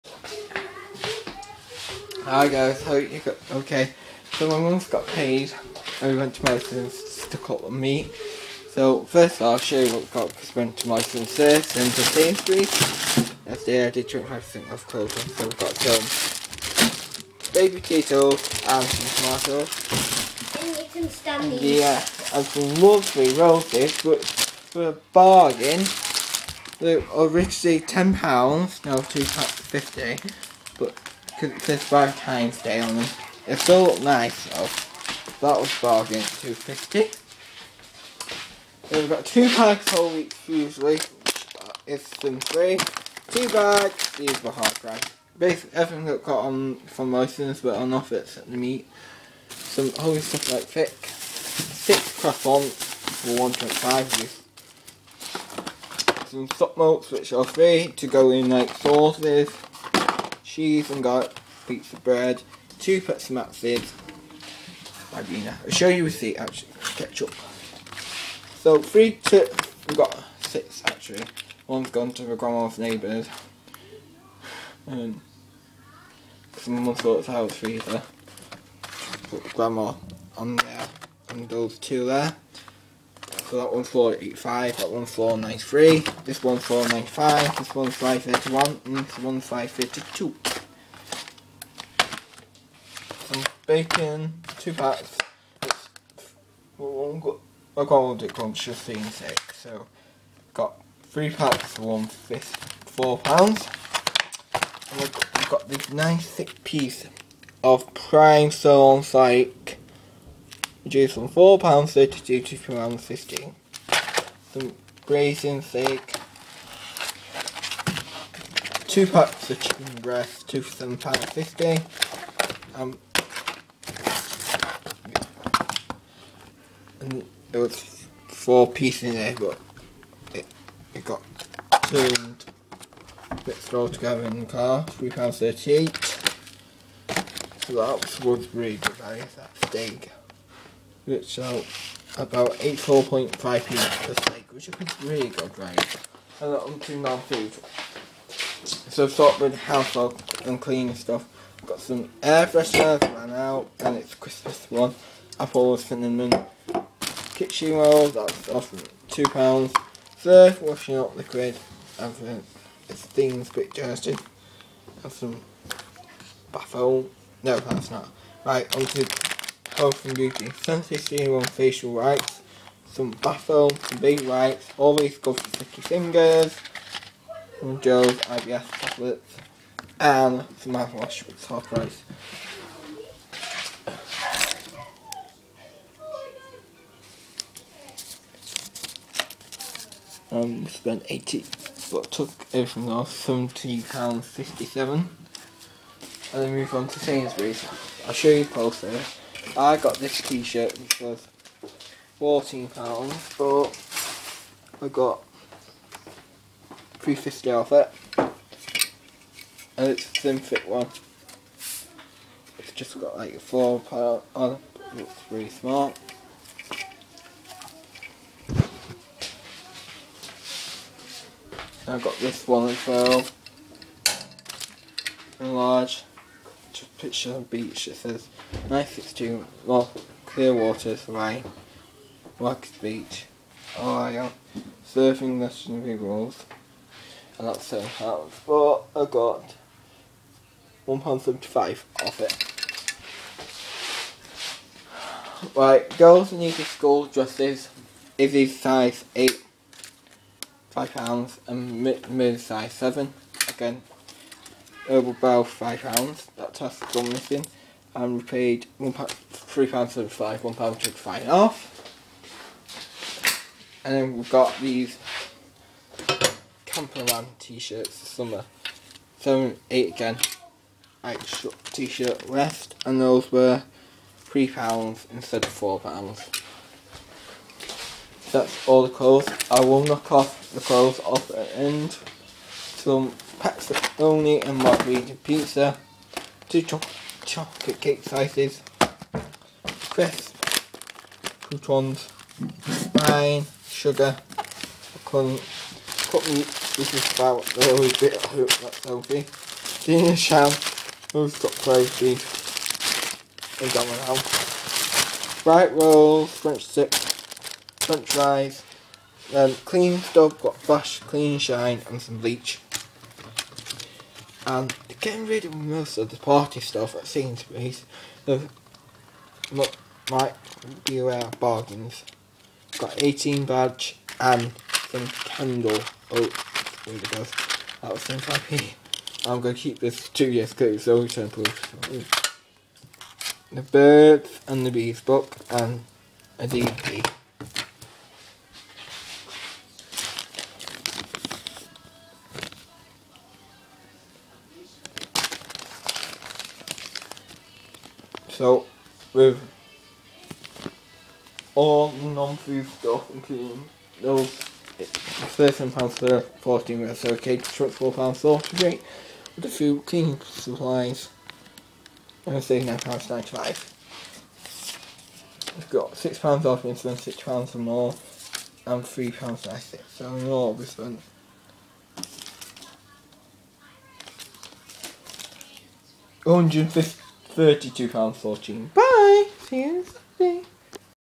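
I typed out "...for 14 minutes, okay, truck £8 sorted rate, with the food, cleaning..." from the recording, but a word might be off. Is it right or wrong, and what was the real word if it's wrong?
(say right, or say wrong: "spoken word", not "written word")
wrong: "4", not "8".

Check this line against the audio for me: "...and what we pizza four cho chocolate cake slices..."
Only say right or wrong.
wrong.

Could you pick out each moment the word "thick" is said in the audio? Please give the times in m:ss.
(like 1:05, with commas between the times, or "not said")
0:50, 1:46.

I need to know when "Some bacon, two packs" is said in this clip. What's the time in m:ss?
1:33.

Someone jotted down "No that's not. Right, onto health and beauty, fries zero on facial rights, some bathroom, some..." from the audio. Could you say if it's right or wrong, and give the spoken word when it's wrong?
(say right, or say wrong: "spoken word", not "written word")
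wrong: "senses", not "fries".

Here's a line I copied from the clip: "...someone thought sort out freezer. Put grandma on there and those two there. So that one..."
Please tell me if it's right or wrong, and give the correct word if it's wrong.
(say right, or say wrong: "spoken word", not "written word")
right.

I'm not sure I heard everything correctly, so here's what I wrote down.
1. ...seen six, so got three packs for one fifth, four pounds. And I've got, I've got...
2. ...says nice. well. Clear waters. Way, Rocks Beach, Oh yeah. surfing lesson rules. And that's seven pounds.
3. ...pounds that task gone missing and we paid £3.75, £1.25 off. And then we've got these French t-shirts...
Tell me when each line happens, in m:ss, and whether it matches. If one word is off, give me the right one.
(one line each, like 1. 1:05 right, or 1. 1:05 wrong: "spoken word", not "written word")
1. 1:38 right
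2. 3:47 right
3. 4:15 wrong: "Camperman", not "French".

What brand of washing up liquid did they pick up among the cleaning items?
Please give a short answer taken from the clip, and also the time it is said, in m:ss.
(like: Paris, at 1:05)
Surf, at 2:40.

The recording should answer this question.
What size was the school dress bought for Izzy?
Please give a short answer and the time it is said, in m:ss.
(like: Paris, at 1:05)
Size 8, at 4:08.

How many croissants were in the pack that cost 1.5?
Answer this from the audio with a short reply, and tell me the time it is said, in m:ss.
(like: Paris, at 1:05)
6, at 0:51.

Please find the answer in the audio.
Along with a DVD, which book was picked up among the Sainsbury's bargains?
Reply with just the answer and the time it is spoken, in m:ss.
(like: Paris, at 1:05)
The Birds and the Bees, at 5:33.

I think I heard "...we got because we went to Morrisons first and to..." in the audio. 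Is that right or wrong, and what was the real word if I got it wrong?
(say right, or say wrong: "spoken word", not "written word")
right.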